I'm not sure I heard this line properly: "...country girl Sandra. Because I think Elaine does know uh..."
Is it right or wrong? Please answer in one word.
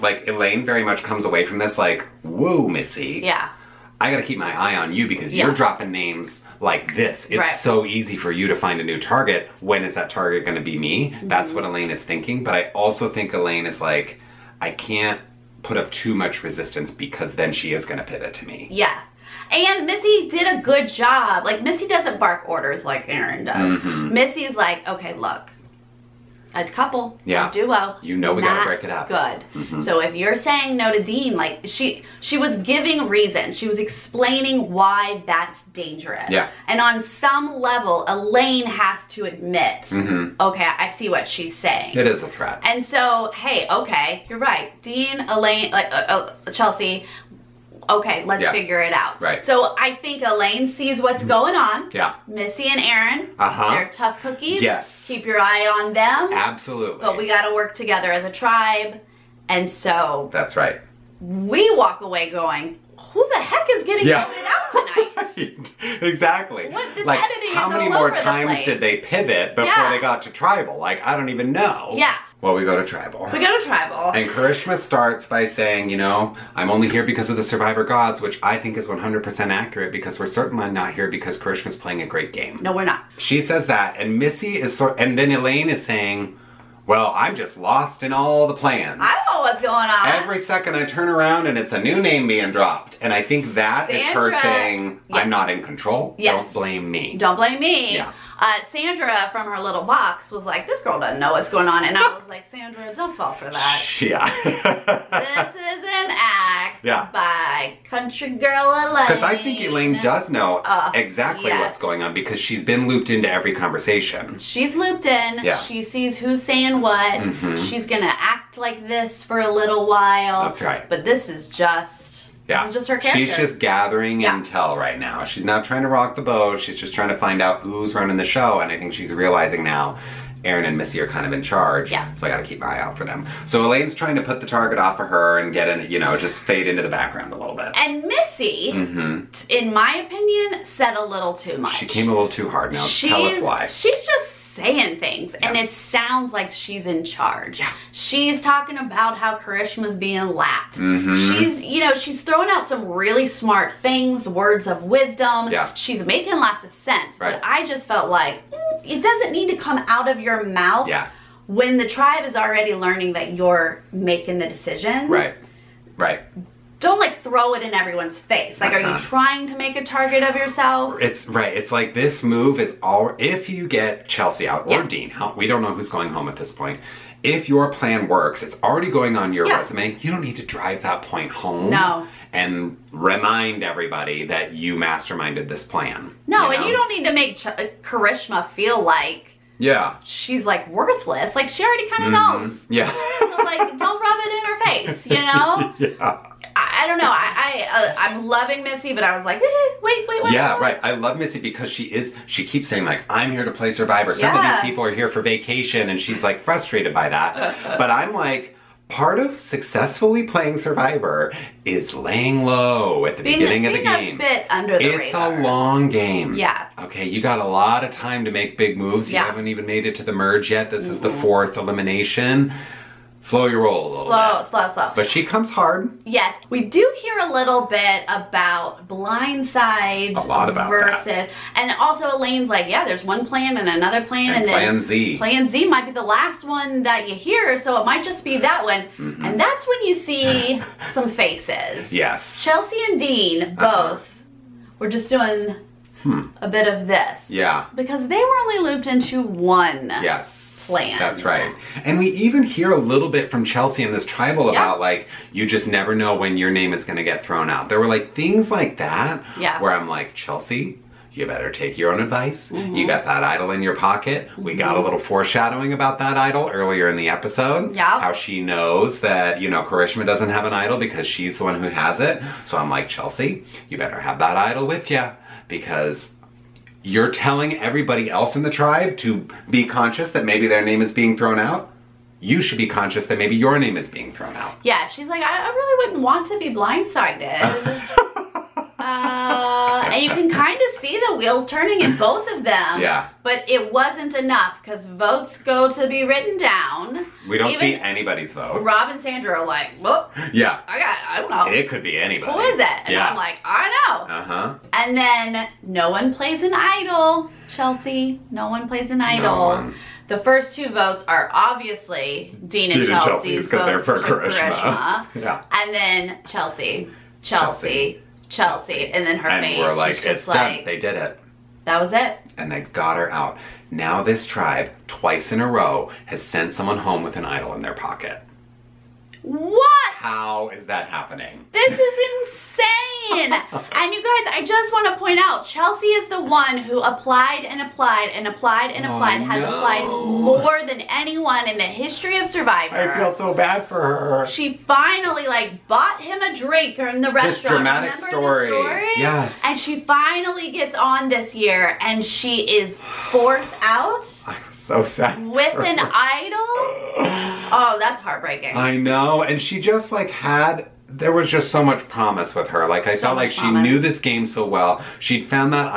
wrong.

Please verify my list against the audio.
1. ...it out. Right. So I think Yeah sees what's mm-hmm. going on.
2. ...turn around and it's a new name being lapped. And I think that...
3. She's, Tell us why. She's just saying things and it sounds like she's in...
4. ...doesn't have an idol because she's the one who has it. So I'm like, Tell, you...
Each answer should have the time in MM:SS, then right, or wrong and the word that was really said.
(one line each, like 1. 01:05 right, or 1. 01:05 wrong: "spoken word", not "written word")
1. 00:48 wrong: "Elaine", not "Yeah"
2. 01:30 wrong: "dropped", not "lapped"
3. 02:22 right
4. 04:30 wrong: "Chelsea", not "Tell".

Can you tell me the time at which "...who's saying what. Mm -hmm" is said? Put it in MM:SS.
01:56.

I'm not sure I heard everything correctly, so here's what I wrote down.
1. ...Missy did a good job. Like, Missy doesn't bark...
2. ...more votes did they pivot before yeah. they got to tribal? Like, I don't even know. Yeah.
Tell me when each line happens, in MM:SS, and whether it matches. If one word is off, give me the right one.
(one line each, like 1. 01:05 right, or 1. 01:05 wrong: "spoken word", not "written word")
1. 00:19 right
2. 01:07 wrong: "times", not "votes".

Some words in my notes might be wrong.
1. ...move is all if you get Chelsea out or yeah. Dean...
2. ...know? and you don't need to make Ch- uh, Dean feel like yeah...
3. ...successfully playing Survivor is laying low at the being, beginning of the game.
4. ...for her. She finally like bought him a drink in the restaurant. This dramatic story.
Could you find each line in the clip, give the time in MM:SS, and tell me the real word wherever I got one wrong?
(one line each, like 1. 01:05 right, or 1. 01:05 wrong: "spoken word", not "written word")
1. 02:52 right
2. 03:06 wrong: "Karishma", not "Dean"
3. 03:29 right
4. 05:43 right.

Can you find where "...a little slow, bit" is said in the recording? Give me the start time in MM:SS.
03:43.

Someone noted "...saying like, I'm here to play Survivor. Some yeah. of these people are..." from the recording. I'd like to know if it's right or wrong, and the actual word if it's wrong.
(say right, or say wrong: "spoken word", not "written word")
right.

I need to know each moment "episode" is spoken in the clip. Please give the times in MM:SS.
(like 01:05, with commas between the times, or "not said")
04:27.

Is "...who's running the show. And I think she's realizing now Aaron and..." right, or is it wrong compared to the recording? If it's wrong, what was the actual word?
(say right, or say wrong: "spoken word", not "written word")
right.